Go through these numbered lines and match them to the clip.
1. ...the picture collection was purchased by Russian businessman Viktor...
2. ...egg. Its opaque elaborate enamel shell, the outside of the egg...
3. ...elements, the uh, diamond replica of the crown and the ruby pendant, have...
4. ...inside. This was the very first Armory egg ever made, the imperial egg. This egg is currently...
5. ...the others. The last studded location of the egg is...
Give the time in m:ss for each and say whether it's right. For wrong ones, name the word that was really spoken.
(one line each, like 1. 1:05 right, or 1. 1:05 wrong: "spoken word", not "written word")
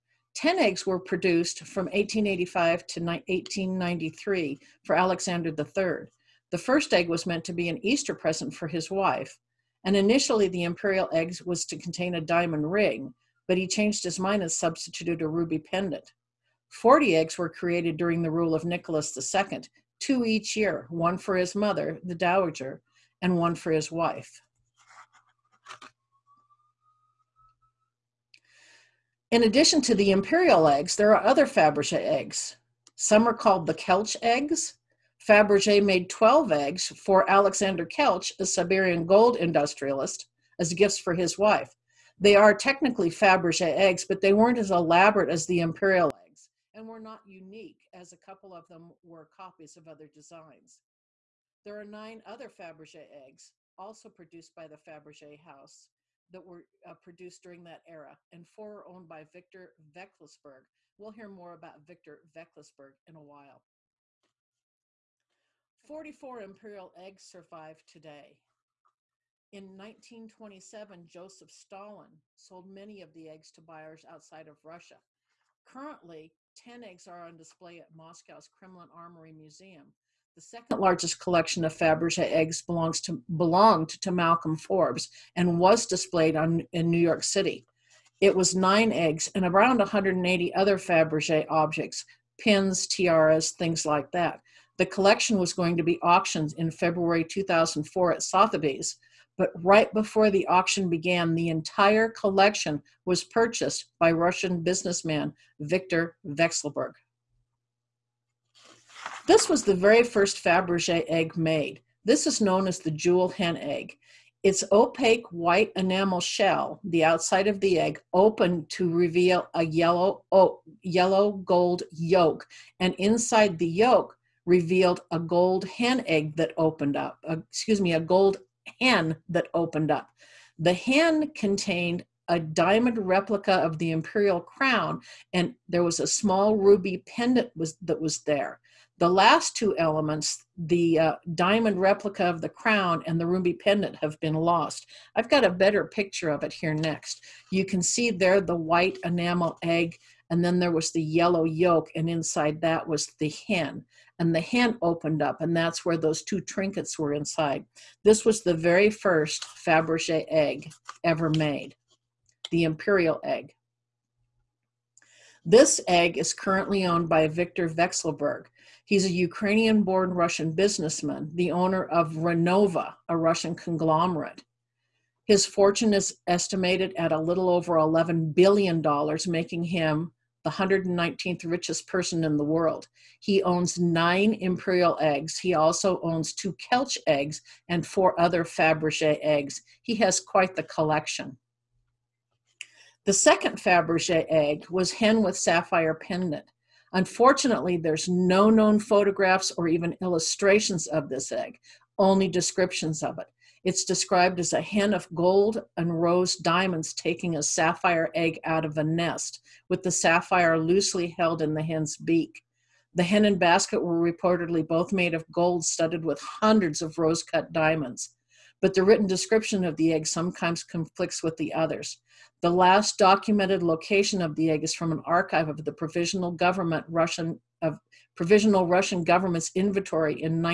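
1. 1:41 wrong: "entire", not "picture"
2. 1:53 wrong: "white", not "elaborate"
3. 2:19 right
4. 2:37 wrong: "Fabergé", not "Armory"
5. 3:41 wrong: "documented", not "studded".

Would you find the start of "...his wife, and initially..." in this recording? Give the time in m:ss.
0:08.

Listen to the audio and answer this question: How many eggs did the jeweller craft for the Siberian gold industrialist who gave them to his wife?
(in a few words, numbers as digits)
12.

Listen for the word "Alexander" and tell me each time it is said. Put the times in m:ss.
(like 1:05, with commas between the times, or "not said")
0:04, 0:37.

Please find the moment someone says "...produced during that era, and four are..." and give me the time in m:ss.
0:56.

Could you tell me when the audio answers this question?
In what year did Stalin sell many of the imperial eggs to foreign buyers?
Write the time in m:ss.
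1:09.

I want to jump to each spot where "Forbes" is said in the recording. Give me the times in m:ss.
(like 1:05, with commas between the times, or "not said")
1:24.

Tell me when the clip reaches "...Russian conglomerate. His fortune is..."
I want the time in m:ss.
2:53.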